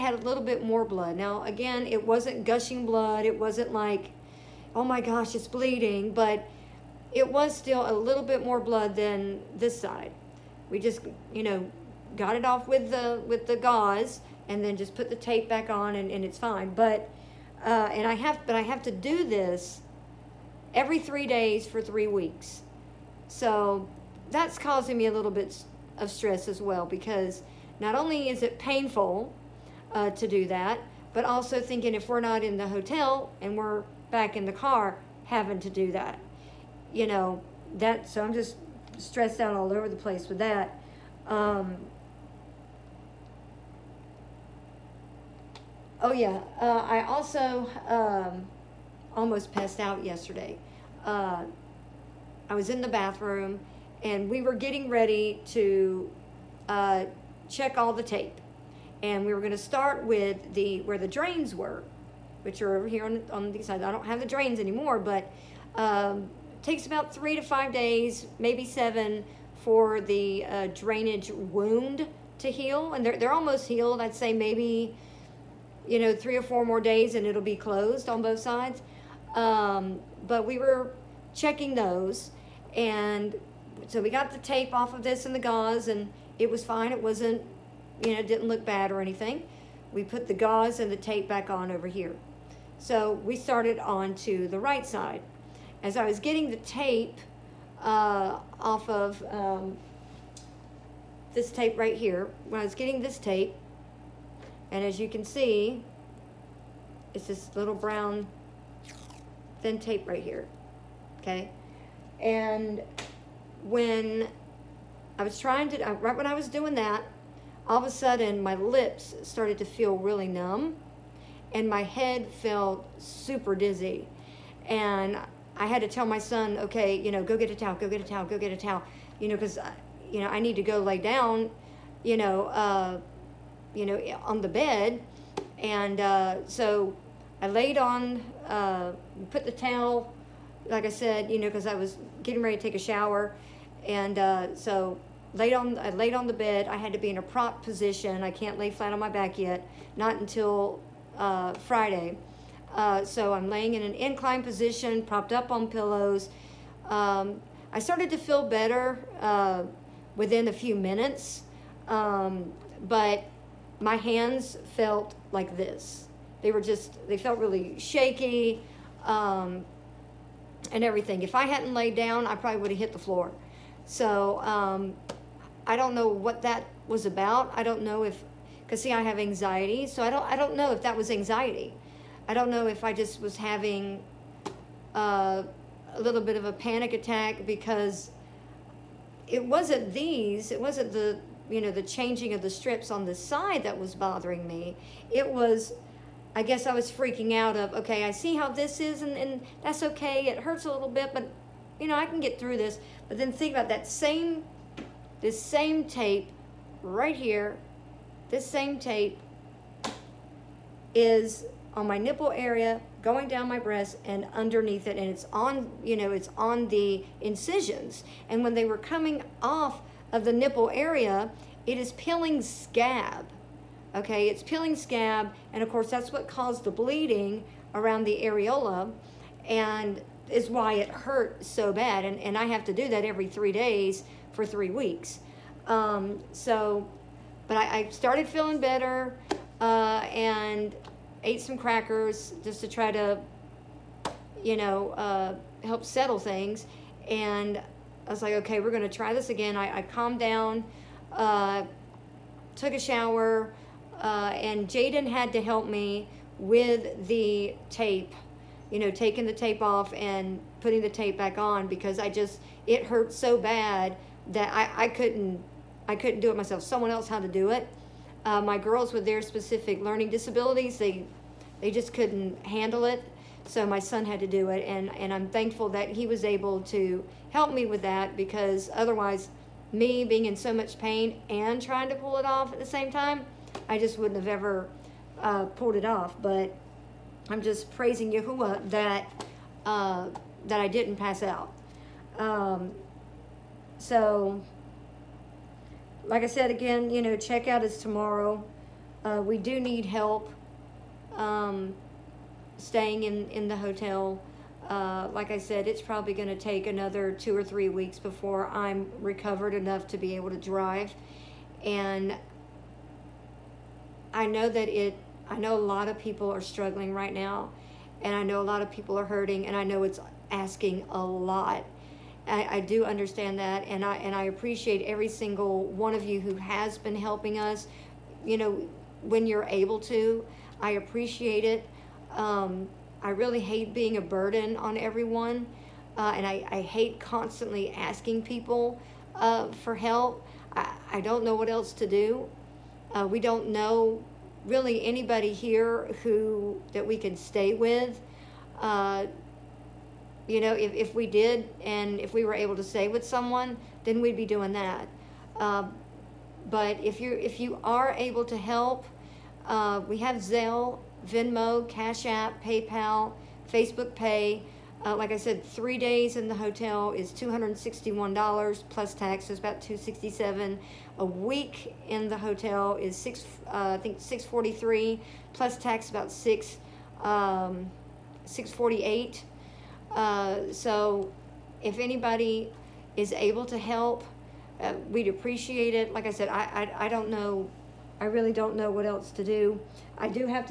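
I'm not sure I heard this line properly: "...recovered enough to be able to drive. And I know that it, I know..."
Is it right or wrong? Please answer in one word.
right.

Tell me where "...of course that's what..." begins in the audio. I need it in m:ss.
3:45.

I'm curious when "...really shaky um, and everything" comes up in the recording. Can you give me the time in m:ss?
2:47.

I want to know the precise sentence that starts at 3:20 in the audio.
It hurts a little bit, but you know, I can get through this.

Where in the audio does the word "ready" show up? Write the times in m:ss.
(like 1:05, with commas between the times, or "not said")
0:54, 2:22.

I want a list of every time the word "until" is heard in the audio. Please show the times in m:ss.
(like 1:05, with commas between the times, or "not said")
2:30.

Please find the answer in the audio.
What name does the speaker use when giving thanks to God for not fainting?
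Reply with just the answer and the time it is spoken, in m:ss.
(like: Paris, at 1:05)
Yahuwah, at 4:48.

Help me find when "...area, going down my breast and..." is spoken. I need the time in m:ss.
3:32.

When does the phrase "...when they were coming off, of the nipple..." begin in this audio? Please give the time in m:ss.
3:38.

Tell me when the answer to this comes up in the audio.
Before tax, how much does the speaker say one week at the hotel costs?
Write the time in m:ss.
6:13.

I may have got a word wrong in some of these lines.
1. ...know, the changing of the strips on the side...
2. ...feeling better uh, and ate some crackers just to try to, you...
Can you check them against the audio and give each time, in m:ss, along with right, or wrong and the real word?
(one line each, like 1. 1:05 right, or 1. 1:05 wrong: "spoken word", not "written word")
1. 3:11 right
2. 3:58 right.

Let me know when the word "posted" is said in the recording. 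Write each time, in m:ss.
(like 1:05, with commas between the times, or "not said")
not said.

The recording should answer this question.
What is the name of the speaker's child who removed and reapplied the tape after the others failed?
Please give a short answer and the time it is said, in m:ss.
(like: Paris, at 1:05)
Jaden, at 4:14.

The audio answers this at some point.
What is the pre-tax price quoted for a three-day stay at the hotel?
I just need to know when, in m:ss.
6:07.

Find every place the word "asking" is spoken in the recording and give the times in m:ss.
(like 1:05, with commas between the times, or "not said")
5:20, 5:37.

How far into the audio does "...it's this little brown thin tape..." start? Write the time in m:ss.
1:47.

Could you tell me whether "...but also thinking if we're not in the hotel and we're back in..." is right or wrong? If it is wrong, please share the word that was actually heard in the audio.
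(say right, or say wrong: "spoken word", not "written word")
right.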